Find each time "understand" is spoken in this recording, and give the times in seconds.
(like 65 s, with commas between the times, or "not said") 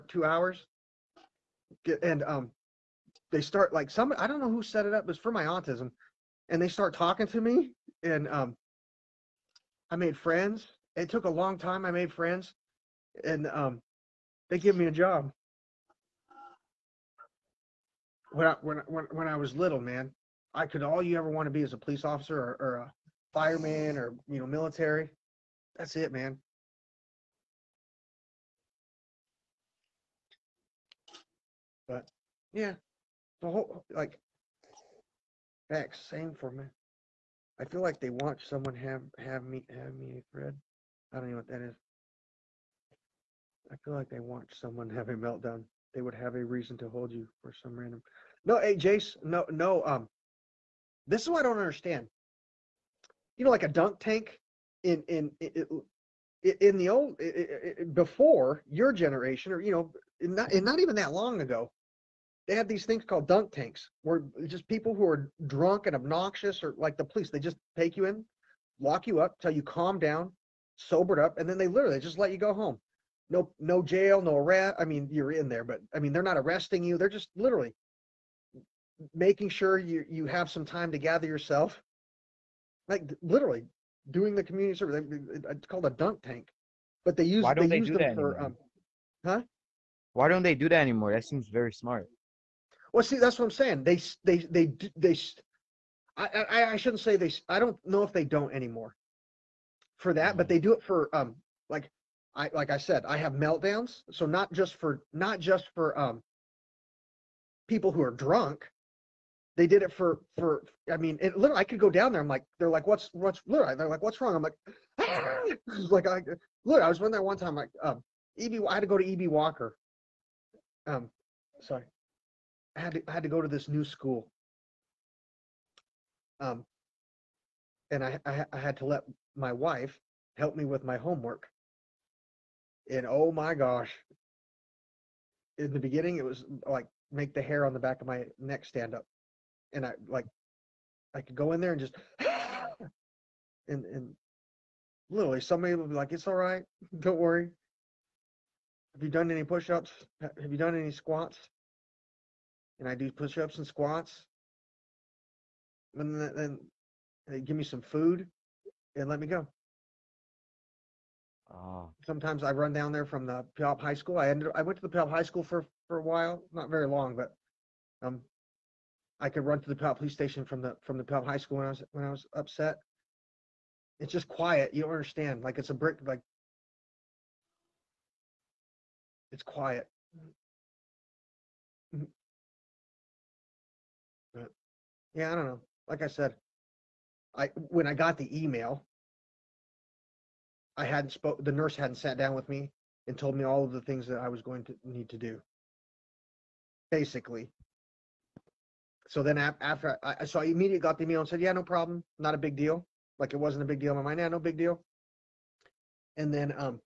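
51 s, 174 s.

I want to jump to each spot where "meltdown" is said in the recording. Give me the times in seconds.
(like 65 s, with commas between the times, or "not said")
45 s, 103 s.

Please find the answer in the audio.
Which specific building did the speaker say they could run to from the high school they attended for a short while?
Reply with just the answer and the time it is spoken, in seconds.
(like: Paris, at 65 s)
Puyallup Police Station, at 169 s.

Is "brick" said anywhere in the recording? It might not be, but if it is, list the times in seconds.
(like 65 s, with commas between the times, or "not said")
175 s.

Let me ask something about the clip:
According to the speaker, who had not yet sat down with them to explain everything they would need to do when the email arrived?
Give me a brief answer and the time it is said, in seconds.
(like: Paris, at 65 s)
The nurse, at 191 s.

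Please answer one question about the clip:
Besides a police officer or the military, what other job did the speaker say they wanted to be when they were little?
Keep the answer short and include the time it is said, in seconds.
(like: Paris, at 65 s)
Fireman, at 23 s.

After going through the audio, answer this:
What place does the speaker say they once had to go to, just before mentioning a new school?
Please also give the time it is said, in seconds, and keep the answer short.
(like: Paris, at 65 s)
EB Walker, at 119 s.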